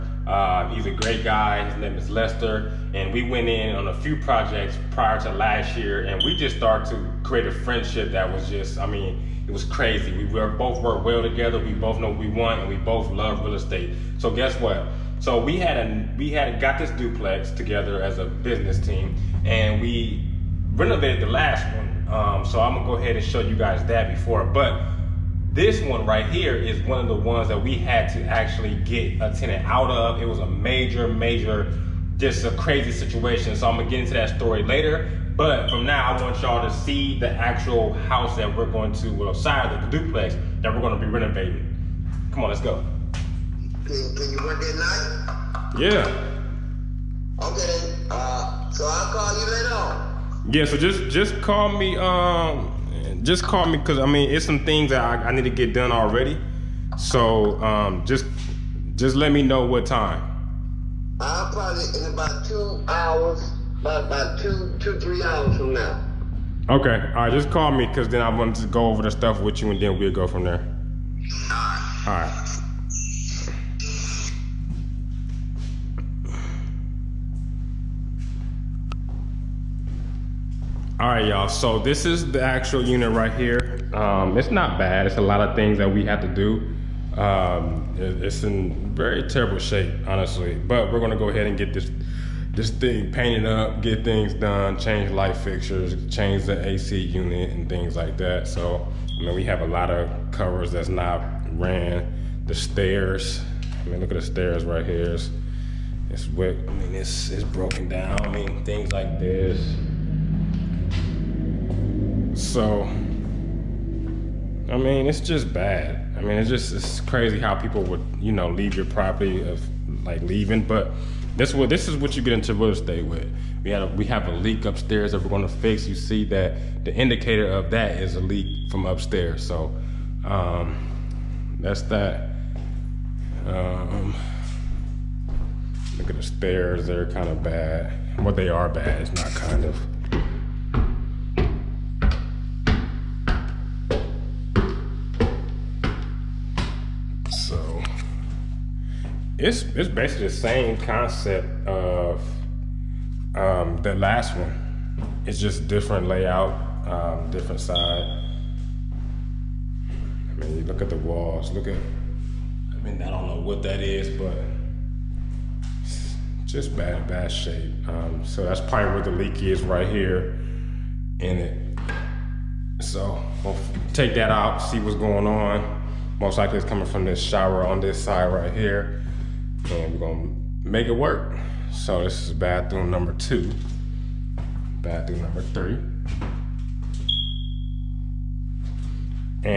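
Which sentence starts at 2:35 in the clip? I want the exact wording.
It's just different layout, um, different side.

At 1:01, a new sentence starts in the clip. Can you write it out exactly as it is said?
I'll probably in about two hours, about about two two three hours from now.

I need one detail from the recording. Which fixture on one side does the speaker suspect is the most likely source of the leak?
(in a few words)
shower.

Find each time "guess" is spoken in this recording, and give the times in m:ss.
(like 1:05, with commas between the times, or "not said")
0:14.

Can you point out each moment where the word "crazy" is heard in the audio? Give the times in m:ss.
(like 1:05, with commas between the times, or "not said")
0:09, 0:32, 1:57.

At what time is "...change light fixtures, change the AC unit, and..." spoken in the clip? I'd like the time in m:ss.
1:34.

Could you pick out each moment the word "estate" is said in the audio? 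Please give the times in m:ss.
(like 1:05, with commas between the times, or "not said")
0:13, 2:02.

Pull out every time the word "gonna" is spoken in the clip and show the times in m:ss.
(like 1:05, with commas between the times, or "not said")
0:22, 0:33, 0:40, 1:31, 3:00.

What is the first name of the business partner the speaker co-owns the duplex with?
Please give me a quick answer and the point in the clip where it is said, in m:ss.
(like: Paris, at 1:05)
Lester, at 0:02.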